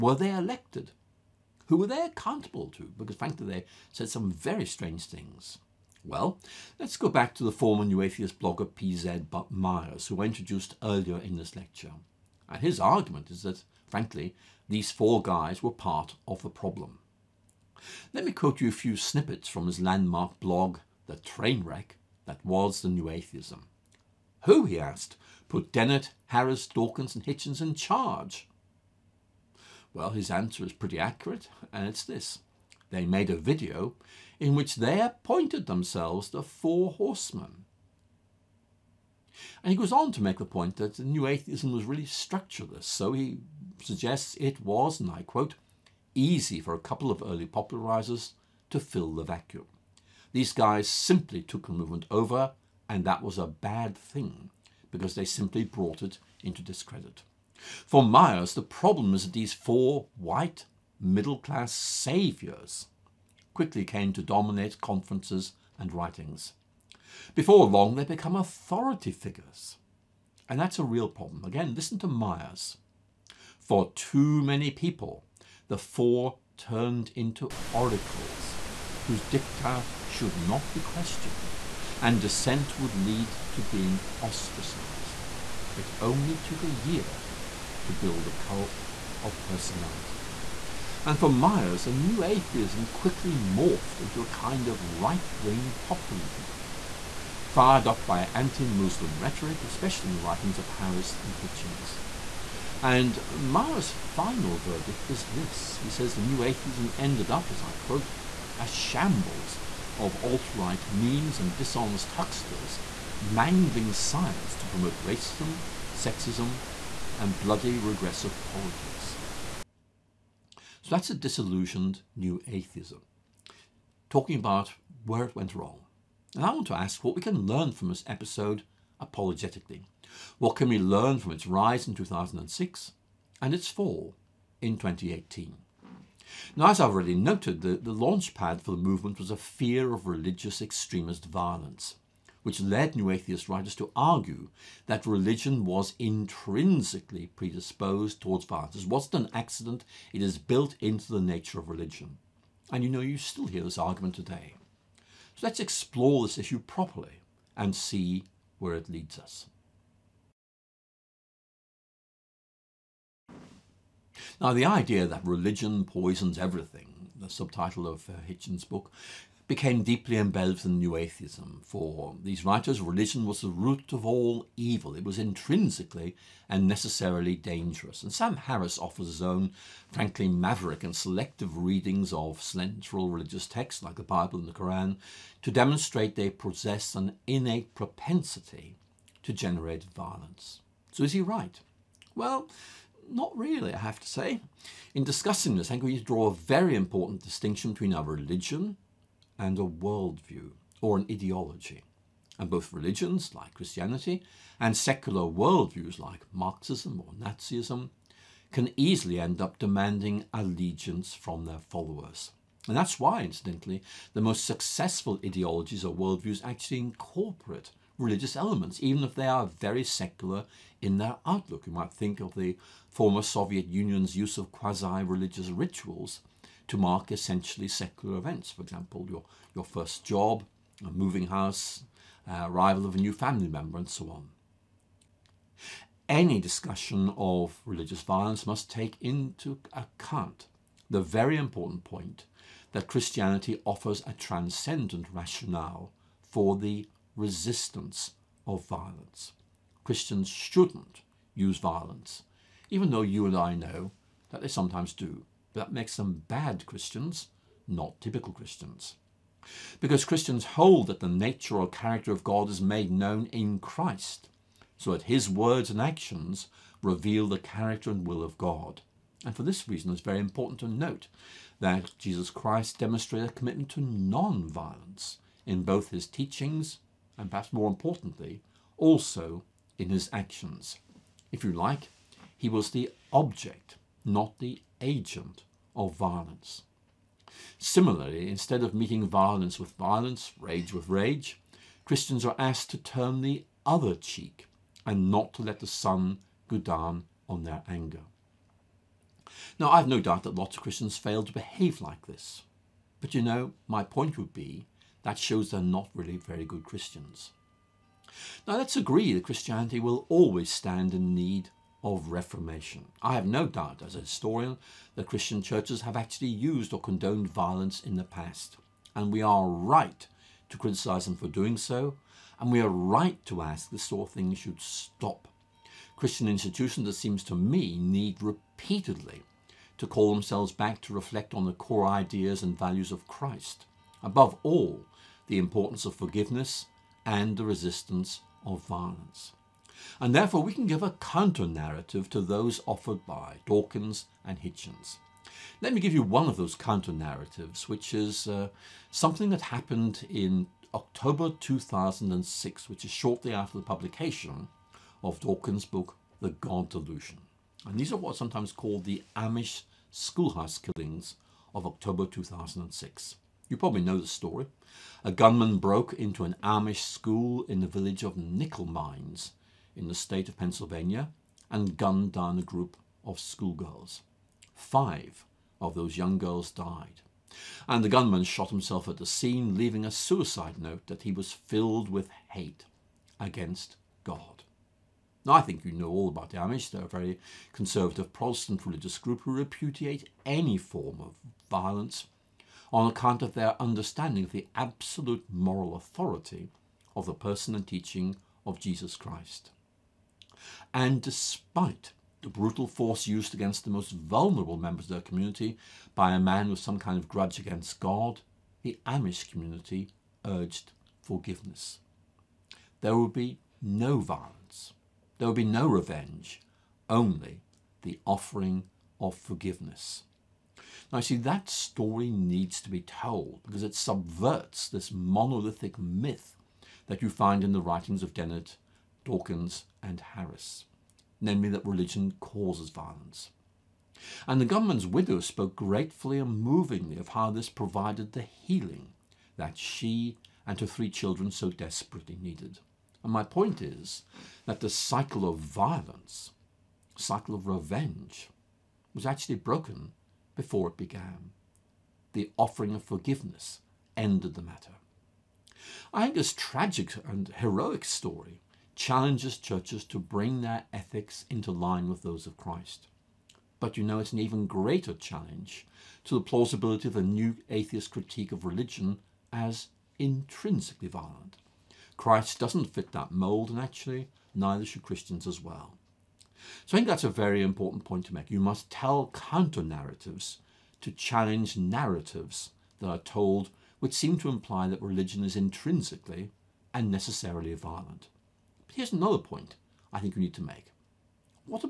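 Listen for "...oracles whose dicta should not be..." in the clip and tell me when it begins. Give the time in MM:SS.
01:17.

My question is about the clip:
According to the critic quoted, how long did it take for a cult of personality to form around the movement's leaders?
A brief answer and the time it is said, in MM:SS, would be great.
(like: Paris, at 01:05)
a year, at 01:26.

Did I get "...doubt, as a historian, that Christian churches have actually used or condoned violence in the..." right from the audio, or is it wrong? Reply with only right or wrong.
right.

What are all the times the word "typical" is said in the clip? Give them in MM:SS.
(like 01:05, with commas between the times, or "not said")
04:17.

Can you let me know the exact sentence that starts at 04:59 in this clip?
Now, I've no doubt that lots of Christians fail to behave like this.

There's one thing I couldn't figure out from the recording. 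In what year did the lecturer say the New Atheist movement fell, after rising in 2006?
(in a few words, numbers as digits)
2018.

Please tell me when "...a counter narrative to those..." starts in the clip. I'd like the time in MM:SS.
05:40.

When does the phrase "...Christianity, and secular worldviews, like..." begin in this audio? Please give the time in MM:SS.
03:23.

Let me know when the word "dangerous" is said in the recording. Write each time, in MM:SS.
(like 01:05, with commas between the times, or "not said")
02:57.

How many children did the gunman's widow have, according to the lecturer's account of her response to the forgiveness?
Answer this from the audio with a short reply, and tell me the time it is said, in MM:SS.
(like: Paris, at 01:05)
3, at 07:20.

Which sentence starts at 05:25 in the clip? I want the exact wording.
Christian institutions, it seems to me, need repeatedly to call themselves back to reflect on the core ideas and values of Christ.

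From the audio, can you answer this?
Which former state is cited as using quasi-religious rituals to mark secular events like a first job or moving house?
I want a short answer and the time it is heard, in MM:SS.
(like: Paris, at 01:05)
Soviet Union, at 03:43.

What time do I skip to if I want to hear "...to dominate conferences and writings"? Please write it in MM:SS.
01:04.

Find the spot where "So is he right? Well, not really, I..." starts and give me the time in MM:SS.
03:10.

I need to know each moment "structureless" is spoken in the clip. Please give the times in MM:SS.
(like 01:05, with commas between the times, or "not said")
00:42.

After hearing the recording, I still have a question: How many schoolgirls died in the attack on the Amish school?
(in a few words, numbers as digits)
5.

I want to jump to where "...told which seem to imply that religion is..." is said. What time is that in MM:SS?
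08:02.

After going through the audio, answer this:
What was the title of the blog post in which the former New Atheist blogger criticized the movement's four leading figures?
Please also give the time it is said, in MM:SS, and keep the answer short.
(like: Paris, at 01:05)
The Trainwreck, at 00:21.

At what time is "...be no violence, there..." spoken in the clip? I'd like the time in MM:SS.
06:53.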